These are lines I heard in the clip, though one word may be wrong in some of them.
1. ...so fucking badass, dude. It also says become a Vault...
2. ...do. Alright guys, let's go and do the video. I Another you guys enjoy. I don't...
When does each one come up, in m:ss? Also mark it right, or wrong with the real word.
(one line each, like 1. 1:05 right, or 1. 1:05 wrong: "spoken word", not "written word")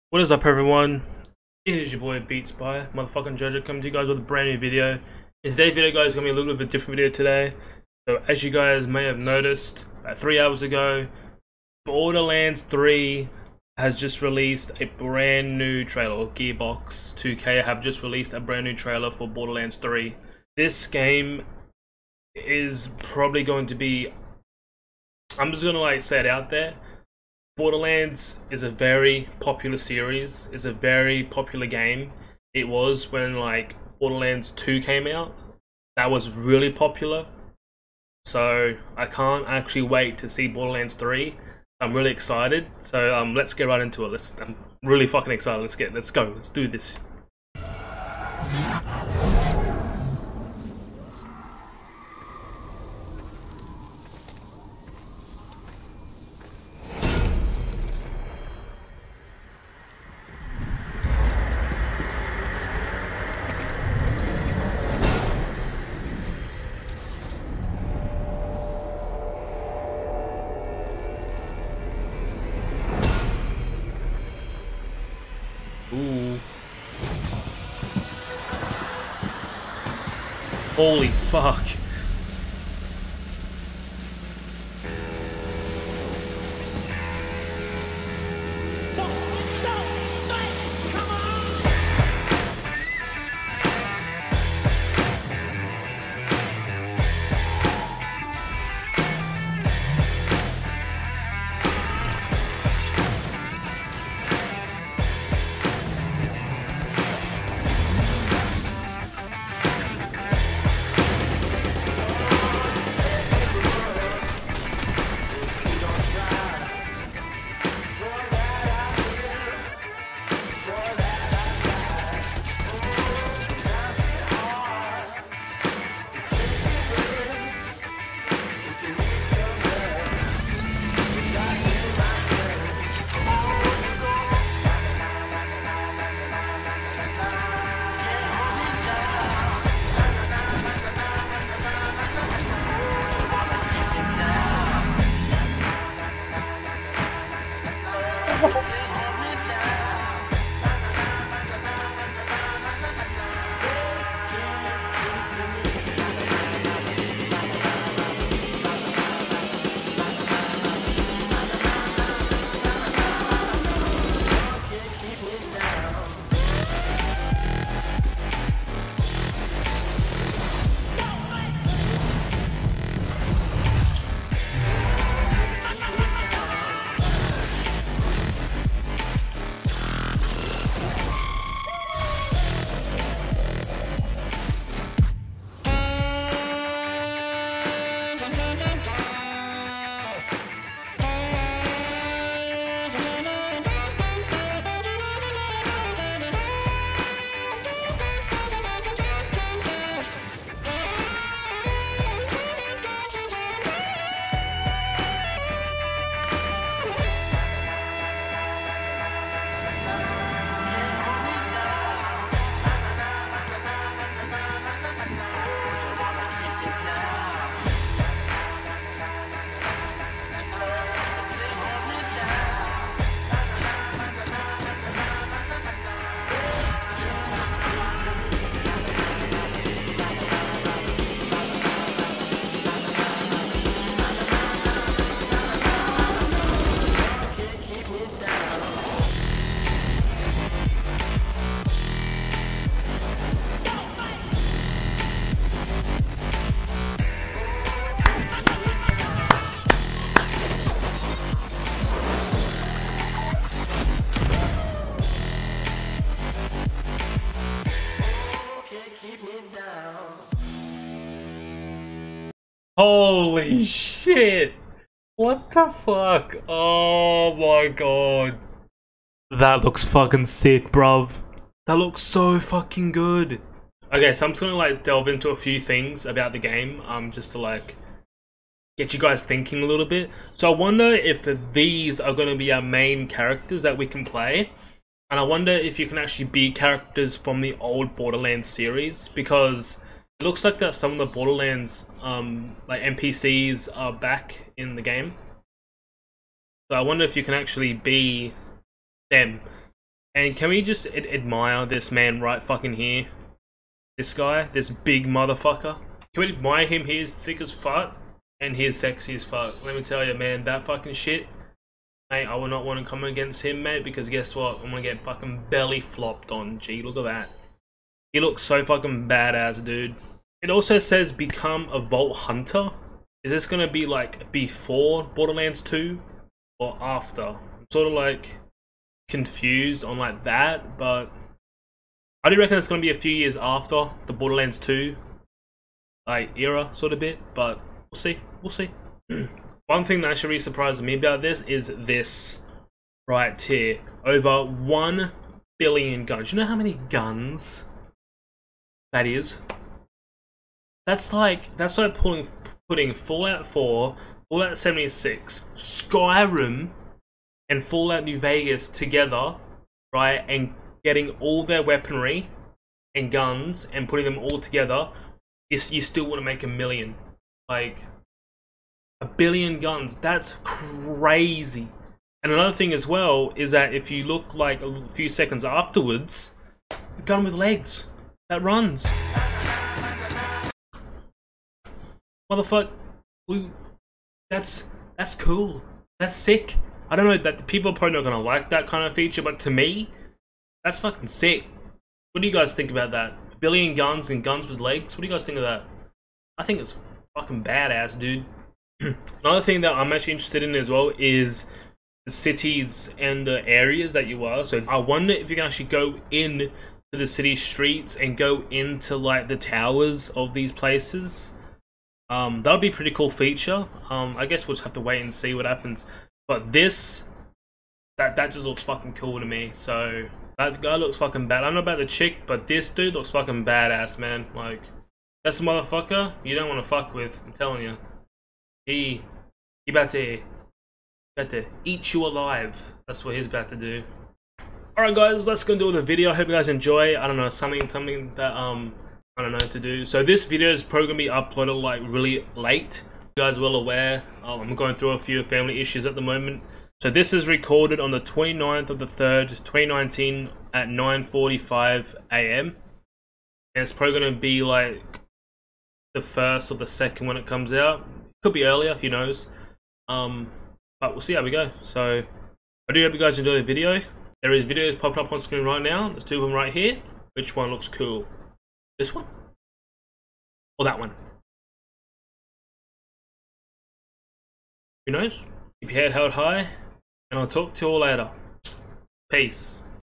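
1. 5:18 right
2. 7:13 wrong: "Hope", not "Another".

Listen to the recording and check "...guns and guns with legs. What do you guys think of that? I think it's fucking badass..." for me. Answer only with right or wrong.
right.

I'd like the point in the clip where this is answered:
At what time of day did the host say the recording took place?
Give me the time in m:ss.
7:30.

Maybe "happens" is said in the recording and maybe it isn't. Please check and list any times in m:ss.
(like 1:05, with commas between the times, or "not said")
6:55.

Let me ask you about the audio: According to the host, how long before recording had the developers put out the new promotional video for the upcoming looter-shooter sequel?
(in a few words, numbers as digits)
3 hours.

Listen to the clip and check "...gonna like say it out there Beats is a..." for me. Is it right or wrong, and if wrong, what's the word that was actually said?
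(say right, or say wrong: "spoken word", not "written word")
wrong: "Borderlands", not "Beats".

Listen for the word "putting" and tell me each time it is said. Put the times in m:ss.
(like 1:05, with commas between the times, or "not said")
5:52, 6:03.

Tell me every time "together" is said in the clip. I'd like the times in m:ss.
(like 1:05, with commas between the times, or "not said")
5:58, 6:04.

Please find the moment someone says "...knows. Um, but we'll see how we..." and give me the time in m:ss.
7:38.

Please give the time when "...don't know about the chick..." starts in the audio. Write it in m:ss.
7:01.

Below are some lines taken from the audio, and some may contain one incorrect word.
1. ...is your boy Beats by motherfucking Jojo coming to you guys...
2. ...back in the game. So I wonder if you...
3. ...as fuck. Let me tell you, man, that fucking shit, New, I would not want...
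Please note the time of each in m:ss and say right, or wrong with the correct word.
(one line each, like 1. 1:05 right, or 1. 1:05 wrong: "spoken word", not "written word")
1. 0:01 right
2. 4:53 right
3. 5:09 wrong: "Hey", not "New".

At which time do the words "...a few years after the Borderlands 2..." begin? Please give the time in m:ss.
5:32.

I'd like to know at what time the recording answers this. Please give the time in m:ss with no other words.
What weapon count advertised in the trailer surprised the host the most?
5:44.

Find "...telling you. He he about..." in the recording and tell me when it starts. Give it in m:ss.
7:07.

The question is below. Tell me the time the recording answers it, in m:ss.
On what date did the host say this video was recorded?
7:28.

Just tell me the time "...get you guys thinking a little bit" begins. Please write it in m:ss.
4:38.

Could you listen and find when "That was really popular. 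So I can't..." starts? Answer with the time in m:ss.
0:35.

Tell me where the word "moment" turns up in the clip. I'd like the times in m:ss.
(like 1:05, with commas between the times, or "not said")
7:26.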